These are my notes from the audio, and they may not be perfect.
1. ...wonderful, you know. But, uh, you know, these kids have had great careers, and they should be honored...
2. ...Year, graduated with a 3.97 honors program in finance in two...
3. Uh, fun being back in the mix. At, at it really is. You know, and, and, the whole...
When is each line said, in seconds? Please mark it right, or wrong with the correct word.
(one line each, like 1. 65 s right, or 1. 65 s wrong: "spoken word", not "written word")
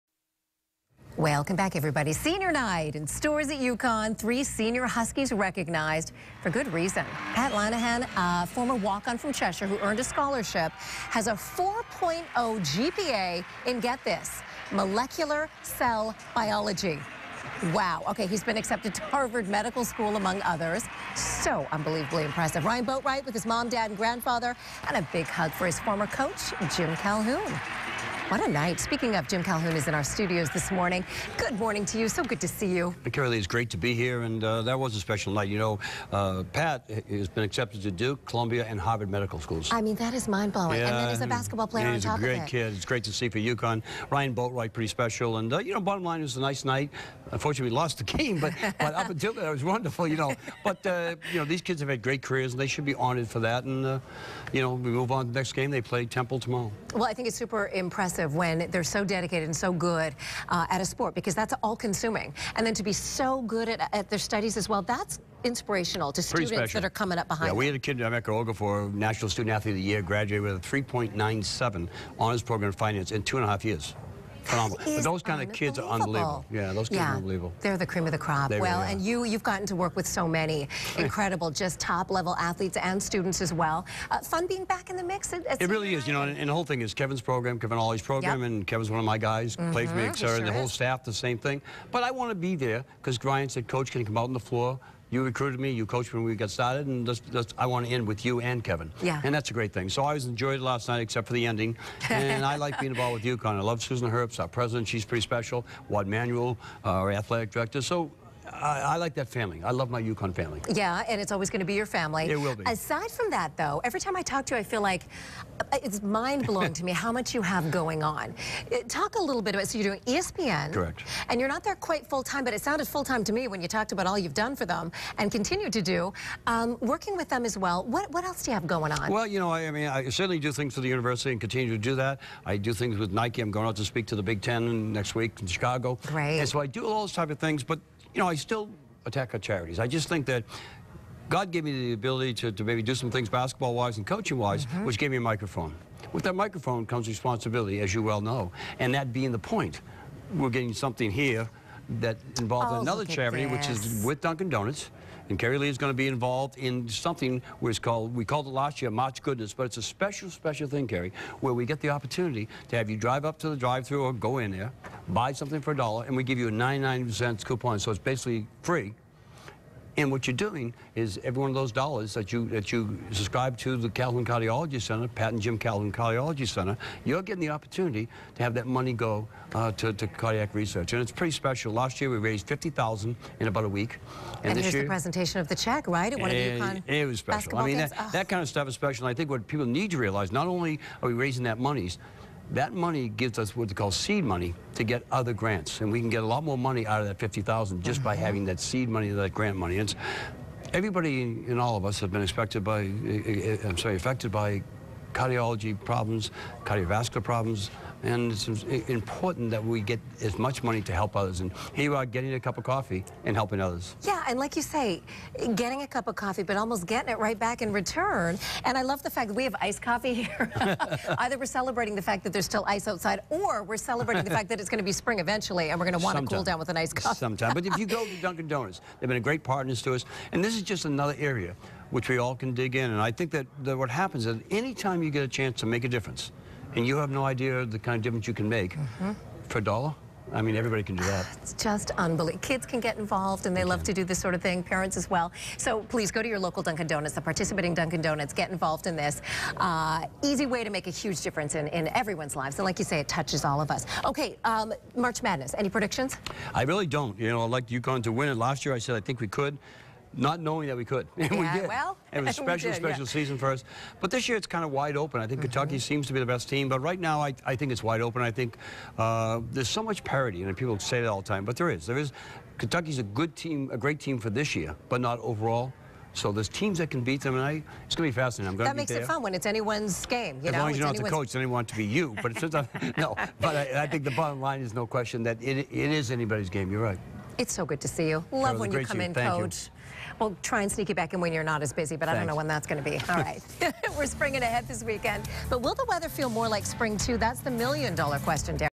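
1. 49 s right
2. 69 s right
3. 84 s right.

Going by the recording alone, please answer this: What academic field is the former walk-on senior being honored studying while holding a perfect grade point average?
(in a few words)
Molecular cell biology.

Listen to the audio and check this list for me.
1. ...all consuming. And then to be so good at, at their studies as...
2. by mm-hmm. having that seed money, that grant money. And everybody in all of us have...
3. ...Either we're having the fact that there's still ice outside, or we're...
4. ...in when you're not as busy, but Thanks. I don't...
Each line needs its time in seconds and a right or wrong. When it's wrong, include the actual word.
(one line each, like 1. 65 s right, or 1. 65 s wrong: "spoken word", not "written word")
1. 61 s right
2. 198 s right
3. 221 s wrong: "celebrating", not "having"
4. 291 s right.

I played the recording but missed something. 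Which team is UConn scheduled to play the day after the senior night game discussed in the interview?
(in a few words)
Temple.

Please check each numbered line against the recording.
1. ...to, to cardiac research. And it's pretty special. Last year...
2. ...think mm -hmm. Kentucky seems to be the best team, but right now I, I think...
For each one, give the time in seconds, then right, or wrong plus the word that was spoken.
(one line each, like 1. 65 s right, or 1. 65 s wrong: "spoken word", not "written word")
1. 179 s right
2. 265 s right.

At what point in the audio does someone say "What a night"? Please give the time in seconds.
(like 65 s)
28 s.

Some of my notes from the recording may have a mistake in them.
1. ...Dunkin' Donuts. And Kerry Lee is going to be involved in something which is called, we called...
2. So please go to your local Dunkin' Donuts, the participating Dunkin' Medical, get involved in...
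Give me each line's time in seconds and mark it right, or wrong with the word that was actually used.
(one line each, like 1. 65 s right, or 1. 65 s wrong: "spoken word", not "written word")
1. 154 s right
2. 245 s wrong: "Donuts", not "Medical".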